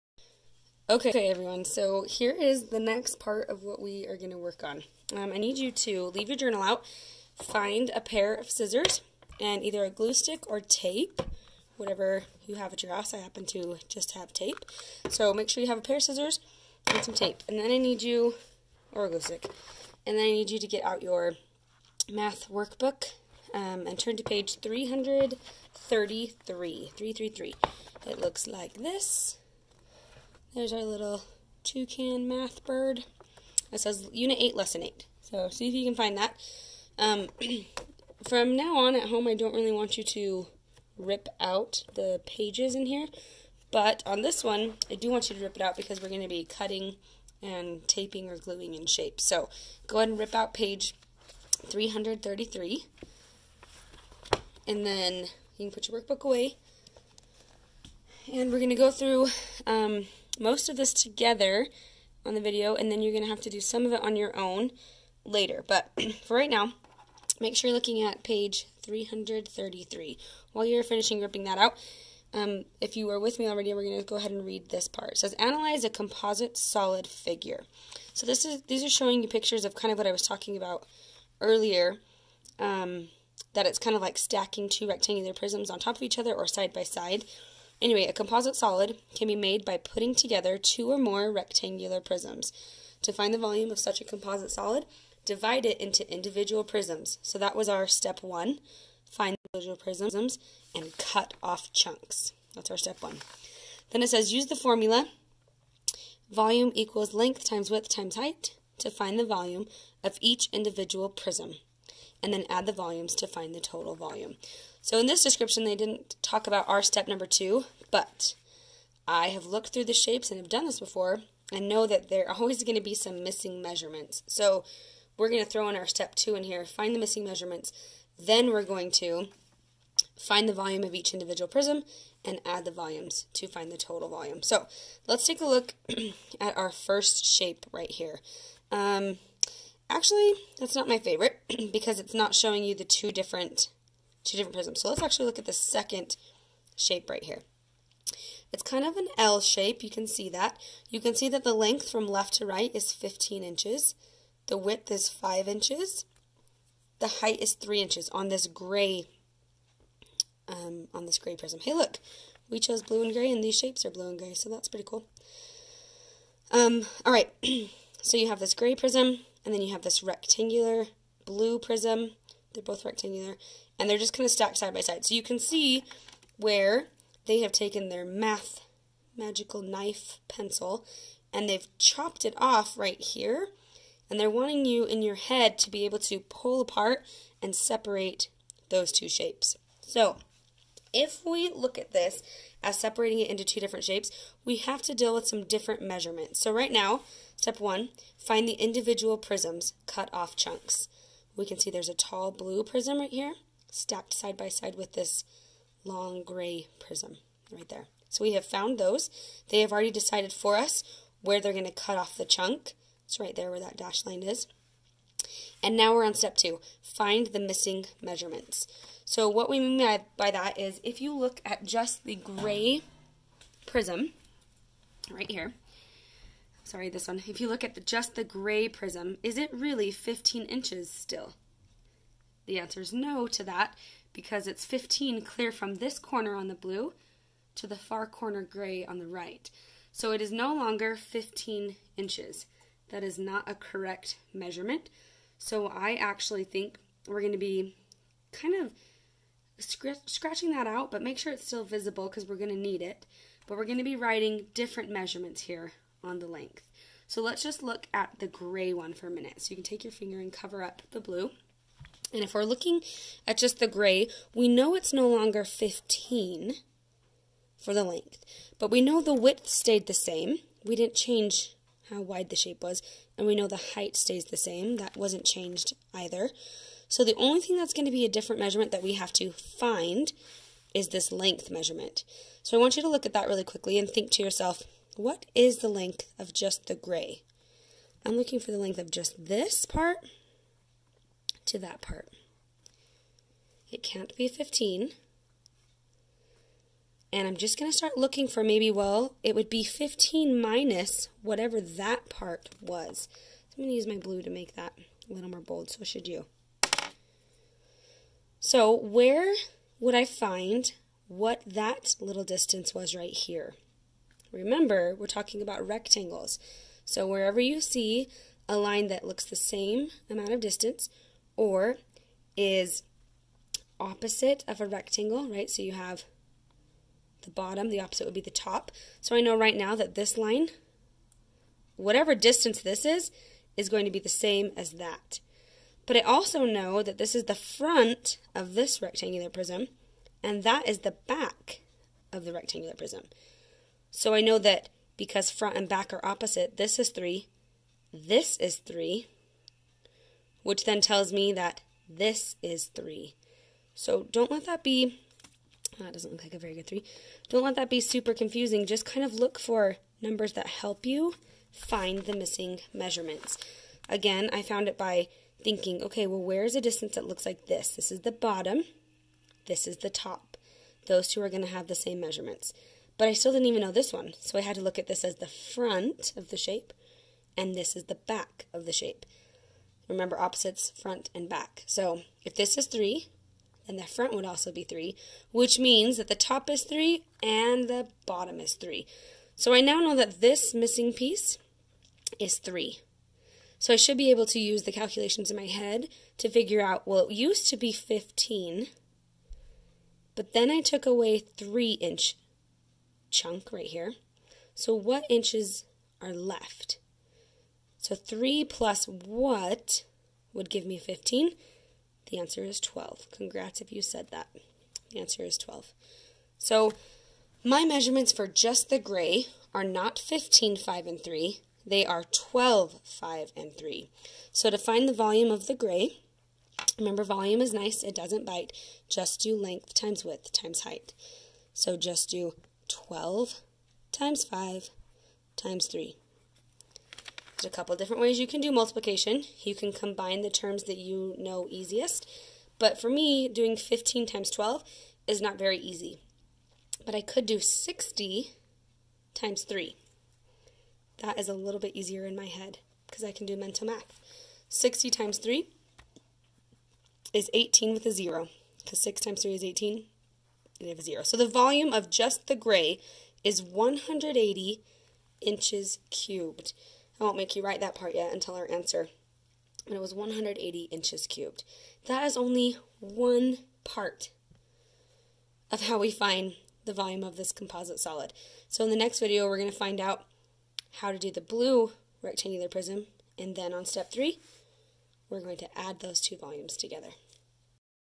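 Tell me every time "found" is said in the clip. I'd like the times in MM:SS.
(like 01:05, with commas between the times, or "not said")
03:28, 06:04.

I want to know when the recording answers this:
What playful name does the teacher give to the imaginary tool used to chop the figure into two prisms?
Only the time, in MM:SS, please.
02:58.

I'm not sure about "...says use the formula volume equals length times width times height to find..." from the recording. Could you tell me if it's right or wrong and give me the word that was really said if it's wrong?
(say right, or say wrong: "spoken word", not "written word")
right.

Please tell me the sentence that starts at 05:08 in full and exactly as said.
So where would I find what that little distance was right here?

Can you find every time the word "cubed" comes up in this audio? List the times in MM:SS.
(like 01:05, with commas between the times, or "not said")
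07:45, 07:51.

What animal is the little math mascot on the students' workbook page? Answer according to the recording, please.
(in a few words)
toucan.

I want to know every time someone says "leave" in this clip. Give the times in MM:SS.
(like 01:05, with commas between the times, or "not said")
00:06.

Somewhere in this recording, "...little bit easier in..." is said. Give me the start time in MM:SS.
07:31.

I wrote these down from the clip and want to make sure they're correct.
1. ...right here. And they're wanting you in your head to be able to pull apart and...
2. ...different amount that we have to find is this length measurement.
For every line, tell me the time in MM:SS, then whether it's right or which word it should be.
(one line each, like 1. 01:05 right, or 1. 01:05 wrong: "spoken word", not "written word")
1. 03:02 right
2. 04:38 wrong: "measurement", not "amount".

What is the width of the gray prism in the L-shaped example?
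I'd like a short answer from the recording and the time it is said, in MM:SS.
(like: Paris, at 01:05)
5 inches, at 02:34.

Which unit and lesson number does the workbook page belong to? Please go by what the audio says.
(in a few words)
Unit 8, Lesson 8.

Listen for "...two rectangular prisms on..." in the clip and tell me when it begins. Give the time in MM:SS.
01:24.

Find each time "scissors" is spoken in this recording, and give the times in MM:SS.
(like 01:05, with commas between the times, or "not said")
00:08, 00:16.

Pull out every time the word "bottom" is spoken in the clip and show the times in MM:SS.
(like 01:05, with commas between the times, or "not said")
05:27, 06:08, 06:28.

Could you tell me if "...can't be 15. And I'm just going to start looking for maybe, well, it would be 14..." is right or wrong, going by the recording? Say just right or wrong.
wrong.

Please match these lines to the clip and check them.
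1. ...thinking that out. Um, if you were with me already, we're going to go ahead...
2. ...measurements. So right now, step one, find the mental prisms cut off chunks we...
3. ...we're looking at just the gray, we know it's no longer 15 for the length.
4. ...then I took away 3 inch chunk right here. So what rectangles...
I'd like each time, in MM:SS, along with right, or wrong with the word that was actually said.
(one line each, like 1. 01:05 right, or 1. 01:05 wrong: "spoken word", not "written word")
1. 01:11 wrong: "ripping", not "thinking"
2. 03:15 wrong: "individual", not "mental"
3. 04:22 right
4. 06:40 wrong: "inches", not "rectangles".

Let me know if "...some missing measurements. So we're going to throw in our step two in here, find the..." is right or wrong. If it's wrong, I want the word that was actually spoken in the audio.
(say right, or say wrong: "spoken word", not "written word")
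right.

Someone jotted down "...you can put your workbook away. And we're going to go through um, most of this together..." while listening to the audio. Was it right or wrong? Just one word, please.
right.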